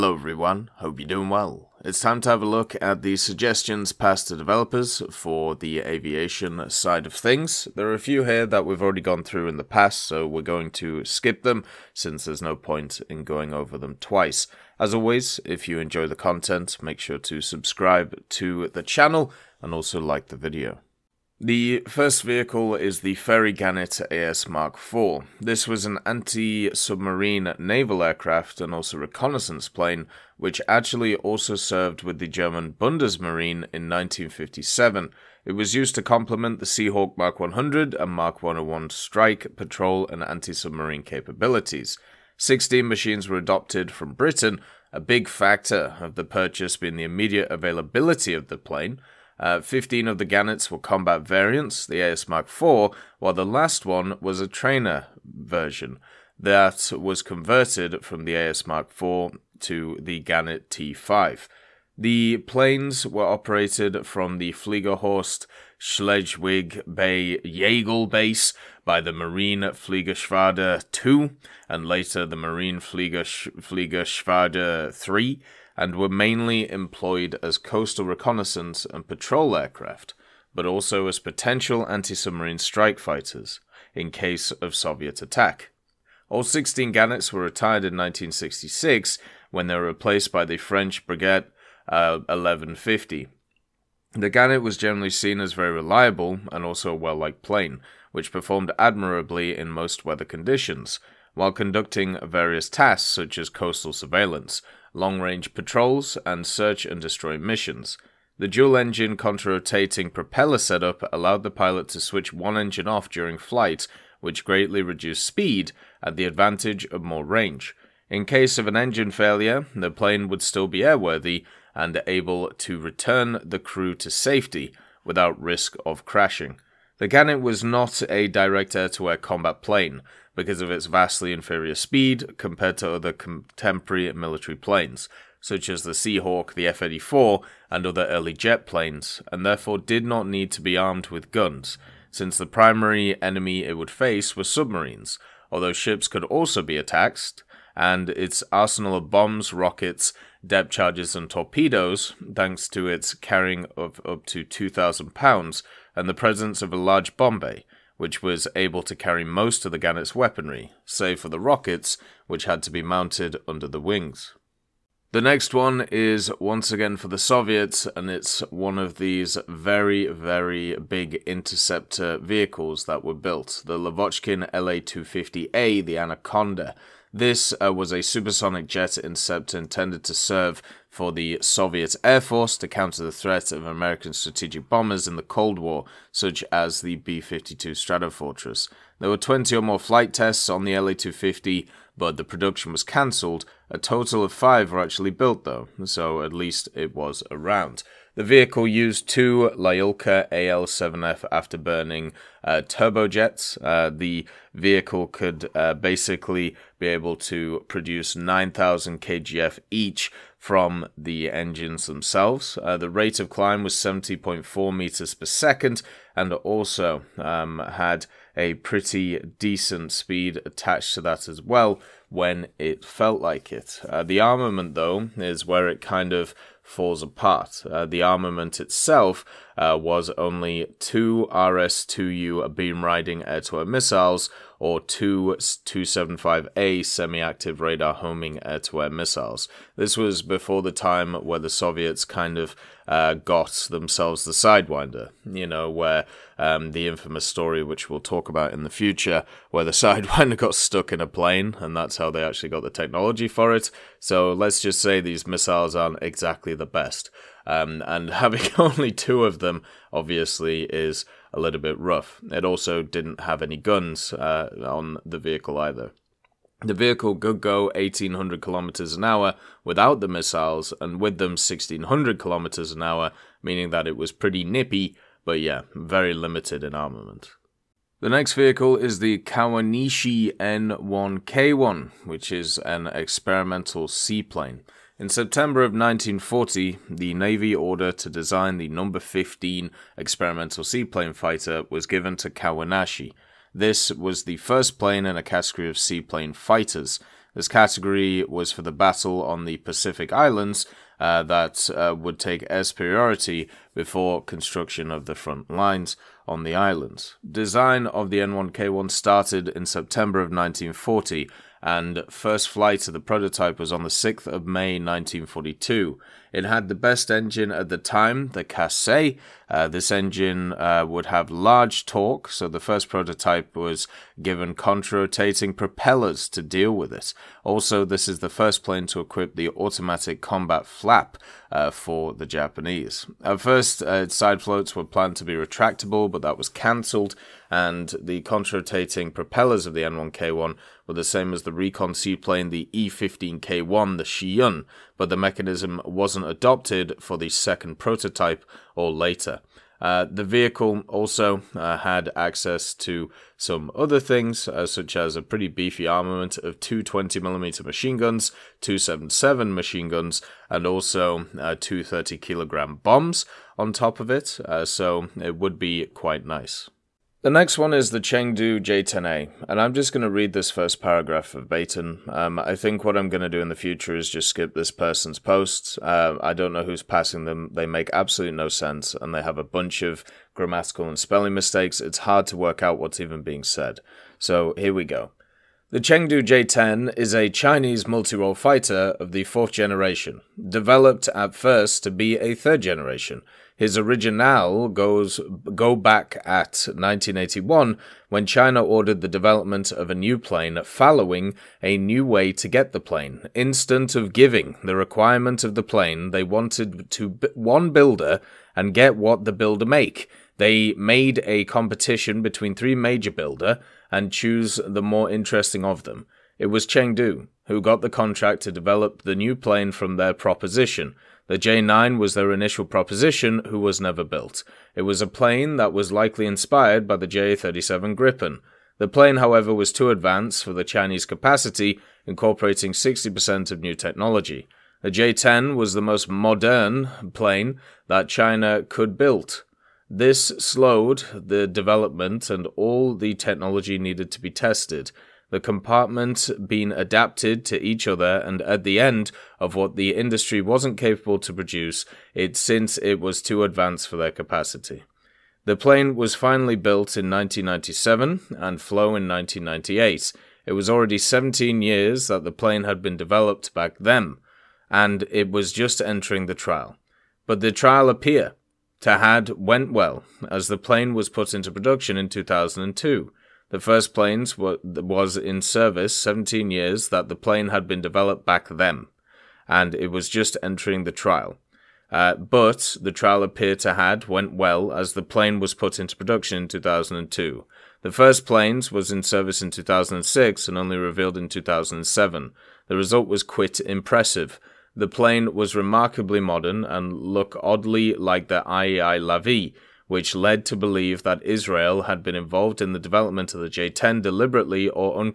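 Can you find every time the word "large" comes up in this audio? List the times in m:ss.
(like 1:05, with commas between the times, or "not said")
2:36, 5:21.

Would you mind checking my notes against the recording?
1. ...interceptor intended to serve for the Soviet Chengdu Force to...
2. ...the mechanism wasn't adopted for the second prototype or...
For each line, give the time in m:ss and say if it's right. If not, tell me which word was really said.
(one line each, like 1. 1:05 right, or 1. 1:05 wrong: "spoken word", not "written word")
1. 2:58 wrong: "Air", not "Chengdu"
2. 5:45 right.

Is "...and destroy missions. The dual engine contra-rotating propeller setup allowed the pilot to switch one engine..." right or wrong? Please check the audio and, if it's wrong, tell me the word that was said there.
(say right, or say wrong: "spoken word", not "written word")
right.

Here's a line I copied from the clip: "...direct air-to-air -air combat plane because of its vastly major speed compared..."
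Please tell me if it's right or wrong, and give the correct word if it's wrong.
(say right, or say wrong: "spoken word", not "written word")
wrong: "inferior", not "major".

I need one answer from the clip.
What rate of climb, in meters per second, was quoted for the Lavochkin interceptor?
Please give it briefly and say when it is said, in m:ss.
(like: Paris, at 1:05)
70.4 meters per second, at 3:33.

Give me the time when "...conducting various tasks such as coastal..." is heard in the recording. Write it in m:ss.
1:41.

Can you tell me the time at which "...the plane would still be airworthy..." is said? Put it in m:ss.
1:59.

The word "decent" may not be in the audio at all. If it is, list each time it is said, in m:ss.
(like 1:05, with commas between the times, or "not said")
3:39.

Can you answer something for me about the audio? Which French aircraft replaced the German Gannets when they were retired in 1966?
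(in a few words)
Breguet 1150.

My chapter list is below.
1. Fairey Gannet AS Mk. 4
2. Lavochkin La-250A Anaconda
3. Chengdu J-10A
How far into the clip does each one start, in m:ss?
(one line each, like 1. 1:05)
1. 0:20
2. 2:44
3. 6:06.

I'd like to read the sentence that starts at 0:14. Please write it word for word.
As always, if you enjoy the content, make sure to subscribe to the channel and also like the video.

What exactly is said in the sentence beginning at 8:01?
Uh, but the trial appeared to had went well as the plane was put into production in 2002.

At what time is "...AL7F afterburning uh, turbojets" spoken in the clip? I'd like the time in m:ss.
3:20.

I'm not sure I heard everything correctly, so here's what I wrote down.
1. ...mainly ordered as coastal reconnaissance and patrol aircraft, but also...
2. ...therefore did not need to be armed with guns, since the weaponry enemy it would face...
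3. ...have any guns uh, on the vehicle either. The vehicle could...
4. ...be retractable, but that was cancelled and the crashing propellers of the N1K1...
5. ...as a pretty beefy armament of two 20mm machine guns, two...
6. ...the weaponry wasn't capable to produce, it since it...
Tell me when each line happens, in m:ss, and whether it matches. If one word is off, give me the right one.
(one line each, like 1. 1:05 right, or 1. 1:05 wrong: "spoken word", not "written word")
1. 1:16 wrong: "employed", not "ordered"
2. 2:19 wrong: "primary", not "weaponry"
3. 4:23 right
4. 5:35 wrong: "contrarotating", not "crashing"
5. 5:54 right
6. 7:29 wrong: "industry", not "weaponry".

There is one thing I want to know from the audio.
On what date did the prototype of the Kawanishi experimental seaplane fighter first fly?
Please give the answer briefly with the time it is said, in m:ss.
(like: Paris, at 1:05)
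6 May 1942, at 5:13.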